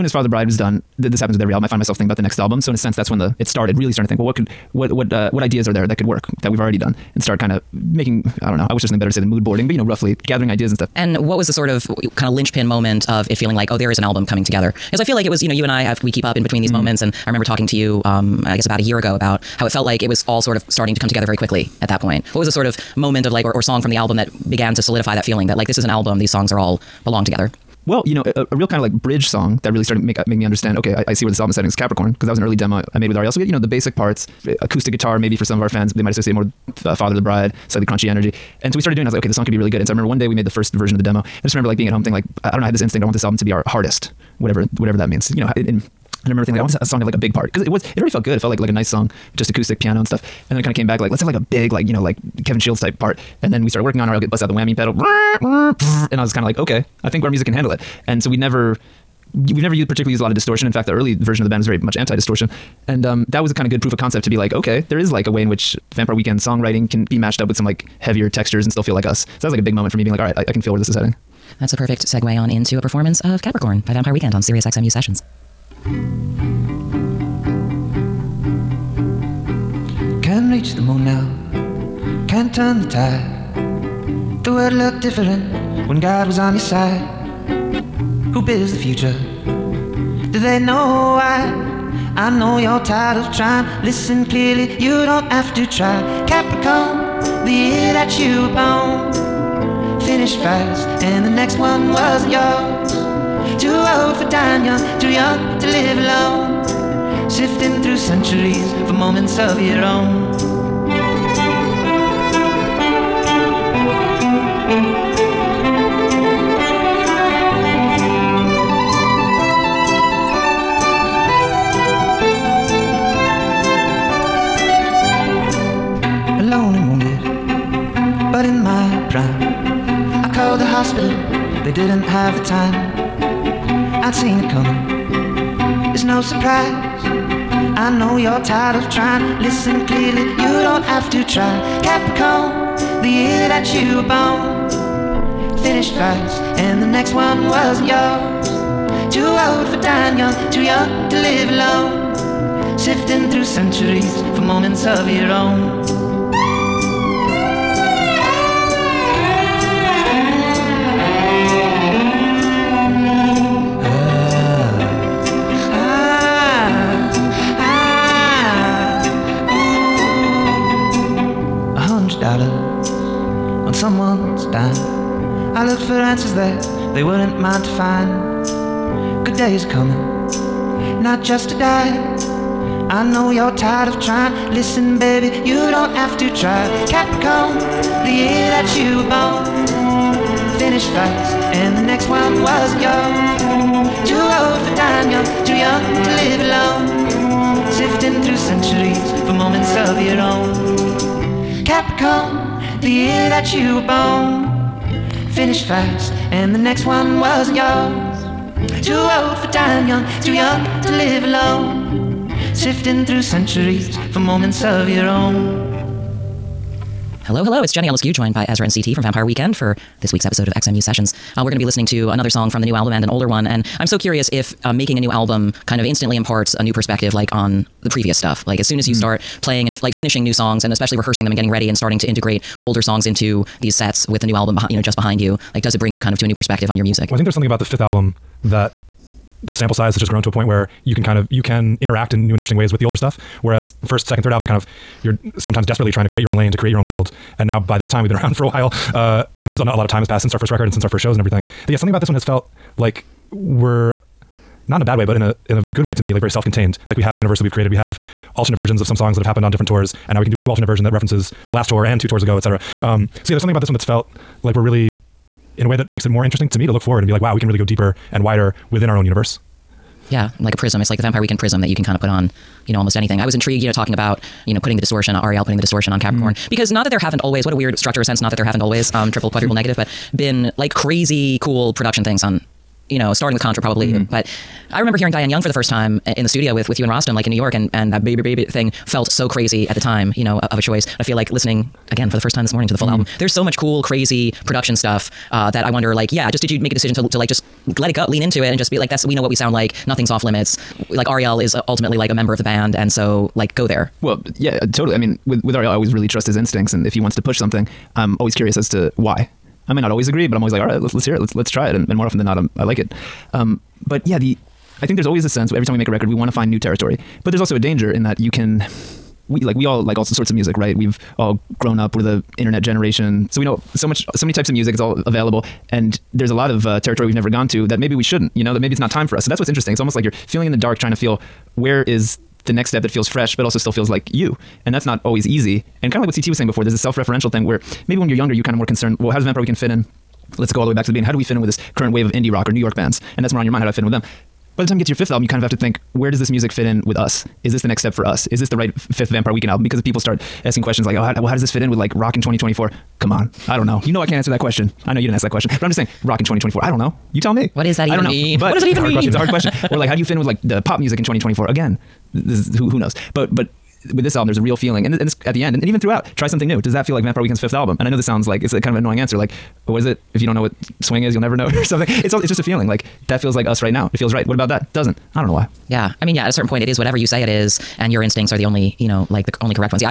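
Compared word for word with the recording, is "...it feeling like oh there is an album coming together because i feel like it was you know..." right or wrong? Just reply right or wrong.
right.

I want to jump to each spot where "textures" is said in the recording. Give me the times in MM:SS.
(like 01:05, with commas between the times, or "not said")
01:08.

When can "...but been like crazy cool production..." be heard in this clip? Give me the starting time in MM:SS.
04:39.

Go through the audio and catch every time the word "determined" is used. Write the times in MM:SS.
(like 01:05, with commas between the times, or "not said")
not said.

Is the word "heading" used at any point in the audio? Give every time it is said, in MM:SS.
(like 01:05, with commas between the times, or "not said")
00:31, 01:10.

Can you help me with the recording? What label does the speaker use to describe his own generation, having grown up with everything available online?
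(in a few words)
internet generation.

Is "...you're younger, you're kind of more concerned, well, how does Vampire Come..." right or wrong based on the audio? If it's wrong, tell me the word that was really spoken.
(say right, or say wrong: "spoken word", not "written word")
wrong: "Weekend", not "Come".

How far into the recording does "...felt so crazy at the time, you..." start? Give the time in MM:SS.
04:48.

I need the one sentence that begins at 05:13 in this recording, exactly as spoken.
Um, but yeah, the I think there's always a sense every time we make a record, we want to find new territory.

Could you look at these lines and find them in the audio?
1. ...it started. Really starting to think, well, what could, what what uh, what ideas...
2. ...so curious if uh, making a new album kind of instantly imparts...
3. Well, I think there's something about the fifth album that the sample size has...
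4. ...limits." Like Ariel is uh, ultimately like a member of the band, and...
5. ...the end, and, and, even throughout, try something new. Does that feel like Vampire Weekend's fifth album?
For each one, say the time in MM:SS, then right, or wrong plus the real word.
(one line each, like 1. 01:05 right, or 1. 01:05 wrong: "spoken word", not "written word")
1. 00:03 right
2. 03:43 right
3. 03:57 right
4. 05:00 right
5. 06:05 right.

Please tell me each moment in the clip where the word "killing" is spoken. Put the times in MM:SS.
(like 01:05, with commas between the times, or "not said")
not said.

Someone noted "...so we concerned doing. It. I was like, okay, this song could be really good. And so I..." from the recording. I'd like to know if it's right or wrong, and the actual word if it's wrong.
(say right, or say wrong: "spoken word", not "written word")
wrong: "started", not "concerned".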